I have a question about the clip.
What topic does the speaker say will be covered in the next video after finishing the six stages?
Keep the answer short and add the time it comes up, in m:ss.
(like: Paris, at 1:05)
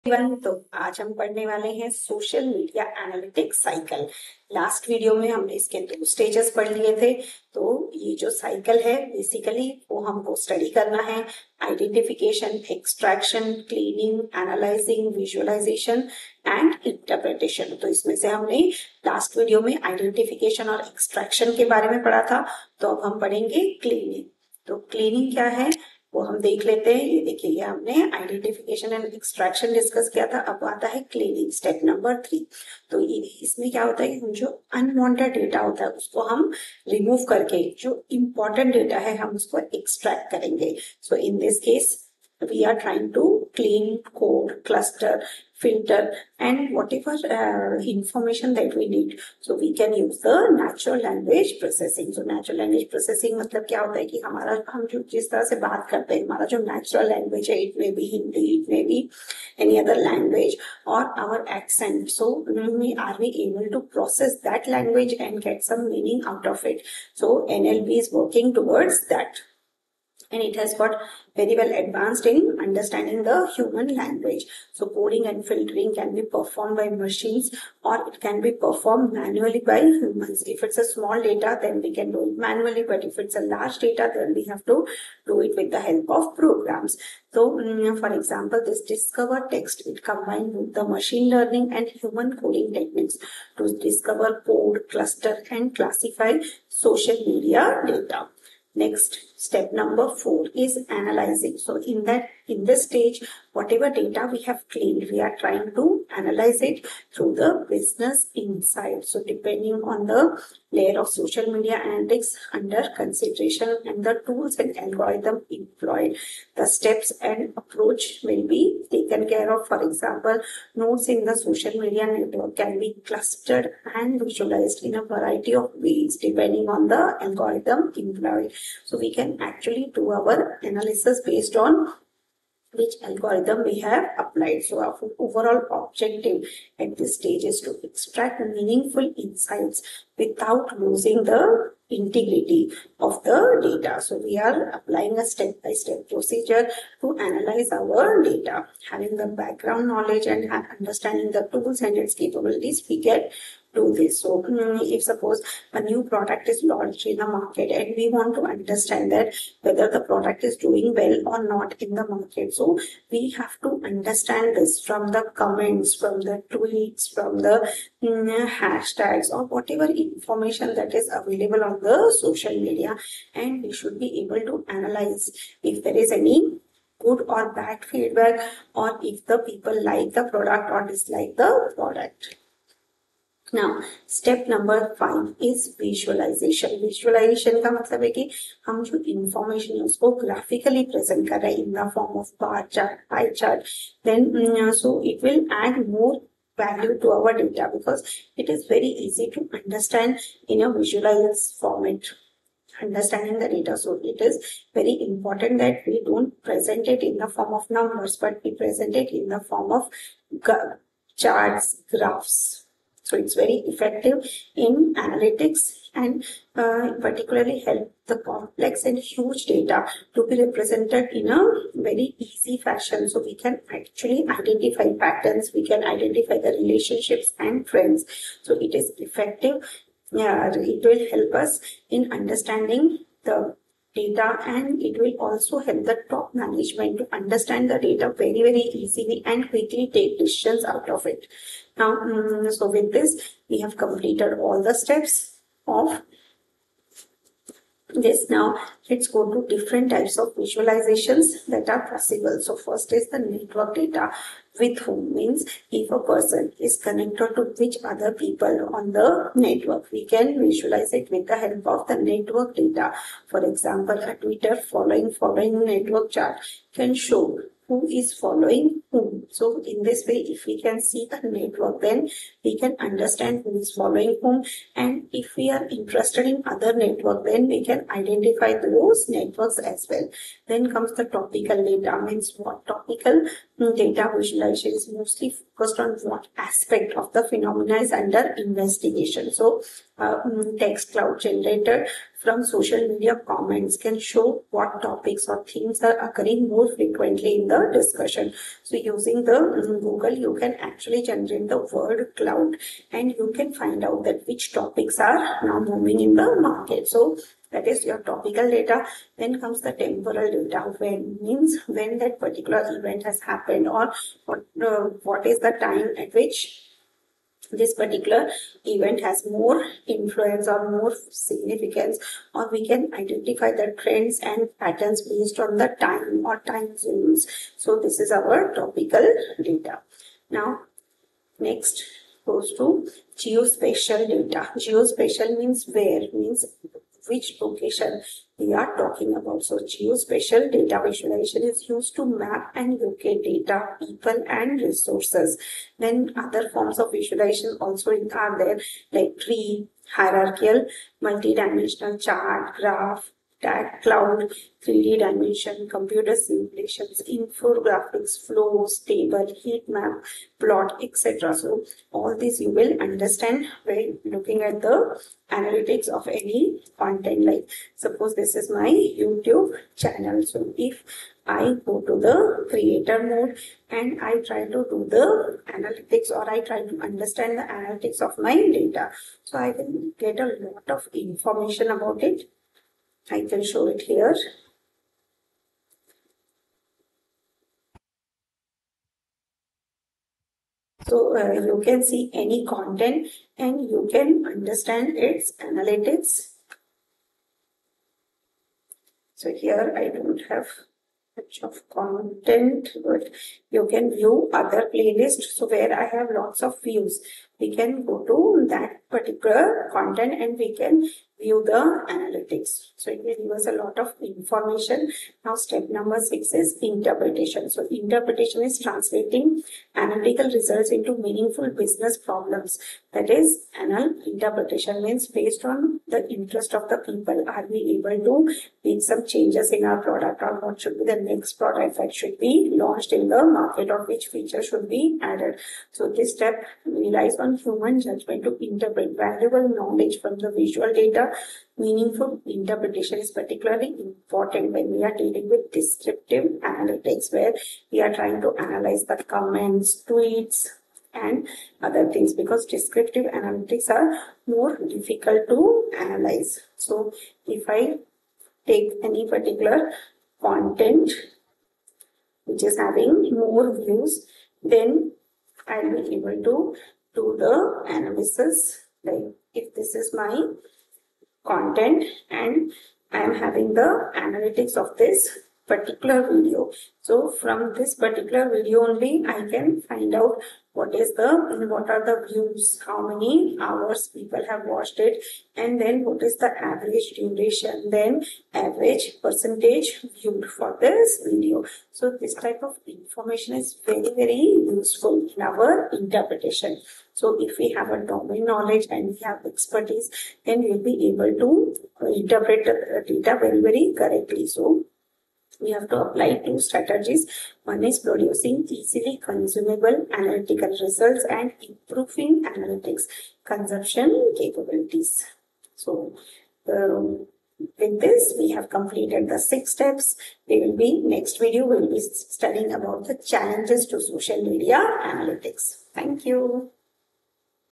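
Challenges to social media analytics, at 8:42.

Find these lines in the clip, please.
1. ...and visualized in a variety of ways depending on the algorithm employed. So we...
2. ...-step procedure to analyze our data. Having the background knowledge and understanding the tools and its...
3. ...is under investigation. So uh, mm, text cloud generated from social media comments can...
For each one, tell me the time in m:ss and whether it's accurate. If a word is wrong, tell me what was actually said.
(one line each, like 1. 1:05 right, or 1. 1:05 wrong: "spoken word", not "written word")
1. 2:03 right
2. 2:25 right
3. 4:47 right.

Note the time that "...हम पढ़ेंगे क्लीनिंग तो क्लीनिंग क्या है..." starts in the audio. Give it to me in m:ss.
0:23.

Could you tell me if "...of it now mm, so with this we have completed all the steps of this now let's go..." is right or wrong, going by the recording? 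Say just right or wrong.
right.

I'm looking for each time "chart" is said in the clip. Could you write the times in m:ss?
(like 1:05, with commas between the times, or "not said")
3:31, 4:26, 5:52.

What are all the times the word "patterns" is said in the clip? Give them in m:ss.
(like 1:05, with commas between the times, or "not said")
3:44, 5:24.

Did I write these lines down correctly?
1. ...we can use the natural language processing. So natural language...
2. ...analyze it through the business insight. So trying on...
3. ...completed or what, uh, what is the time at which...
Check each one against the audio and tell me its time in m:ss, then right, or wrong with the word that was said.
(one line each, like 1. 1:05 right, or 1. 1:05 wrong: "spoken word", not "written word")
1. 0:49 right
2. 1:46 wrong: "depending", not "trying"
3. 5:13 wrong: "happened", not "completed".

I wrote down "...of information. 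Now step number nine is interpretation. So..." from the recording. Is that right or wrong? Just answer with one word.
wrong.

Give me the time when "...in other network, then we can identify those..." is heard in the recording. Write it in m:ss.
4:36.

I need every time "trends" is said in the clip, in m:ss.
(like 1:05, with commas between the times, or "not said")
3:47, 5:23.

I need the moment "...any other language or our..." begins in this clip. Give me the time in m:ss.
0:59.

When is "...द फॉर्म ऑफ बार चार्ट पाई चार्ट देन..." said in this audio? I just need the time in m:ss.
3:11.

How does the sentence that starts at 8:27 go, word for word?
One is producing easily consumable analytical results and improving analytics consumption capabilities.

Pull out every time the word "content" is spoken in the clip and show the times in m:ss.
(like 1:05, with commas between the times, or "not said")
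6:06, 6:32, 6:41, 6:49, 7:40, 7:51.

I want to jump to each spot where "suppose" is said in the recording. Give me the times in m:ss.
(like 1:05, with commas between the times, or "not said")
2:35, 6:07.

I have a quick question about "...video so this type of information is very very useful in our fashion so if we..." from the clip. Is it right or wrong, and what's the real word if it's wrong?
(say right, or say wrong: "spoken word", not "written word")
wrong: "interpretation", not "fashion".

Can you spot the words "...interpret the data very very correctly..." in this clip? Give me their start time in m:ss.
8:22.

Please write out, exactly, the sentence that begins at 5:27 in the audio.
So this is our topical data.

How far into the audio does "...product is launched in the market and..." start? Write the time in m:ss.
2:36.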